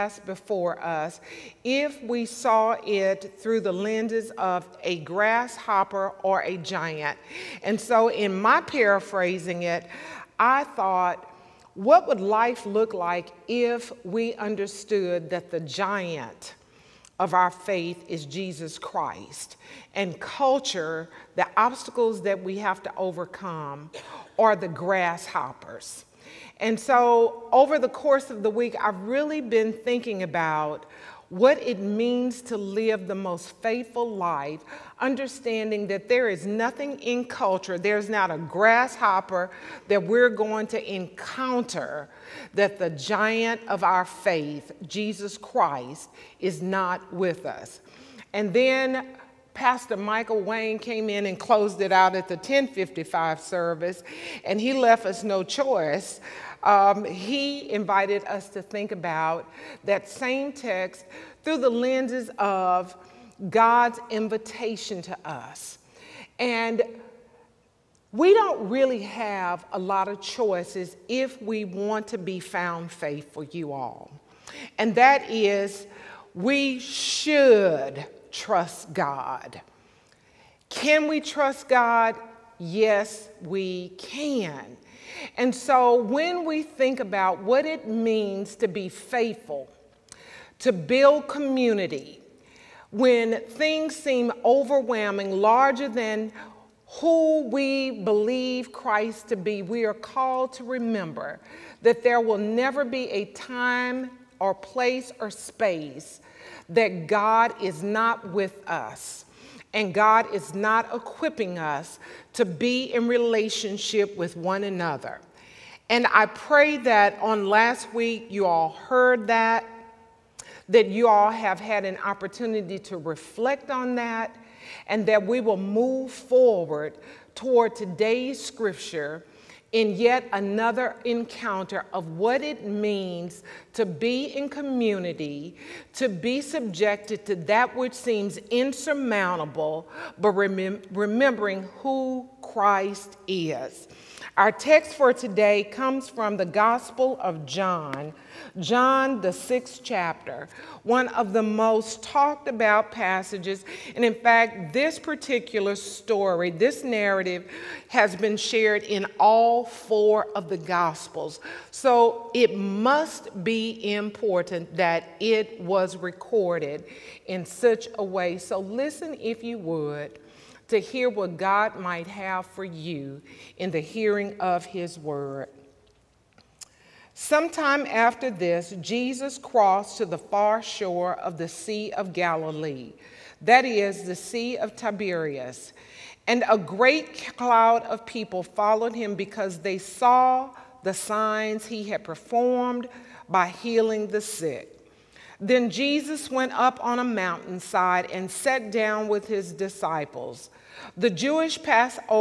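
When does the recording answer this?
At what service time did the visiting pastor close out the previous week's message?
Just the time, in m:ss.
0:52.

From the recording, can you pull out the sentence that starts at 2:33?
And in fact, this particular story, this narrative, has been shared in all four of the Gospels.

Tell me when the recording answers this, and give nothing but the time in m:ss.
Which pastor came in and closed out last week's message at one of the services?
0:49.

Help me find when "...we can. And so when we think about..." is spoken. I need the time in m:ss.
1:23.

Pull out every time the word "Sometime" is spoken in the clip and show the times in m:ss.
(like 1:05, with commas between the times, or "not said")
2:57.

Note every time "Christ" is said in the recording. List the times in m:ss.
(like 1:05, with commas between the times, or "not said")
0:18, 0:45, 1:38, 2:22.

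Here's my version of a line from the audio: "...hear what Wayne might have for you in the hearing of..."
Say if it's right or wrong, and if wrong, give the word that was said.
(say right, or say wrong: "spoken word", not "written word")
wrong: "God", not "Wayne".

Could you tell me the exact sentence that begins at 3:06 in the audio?
And a great cloud of people followed him because they saw the signs he had performed by healing the sick.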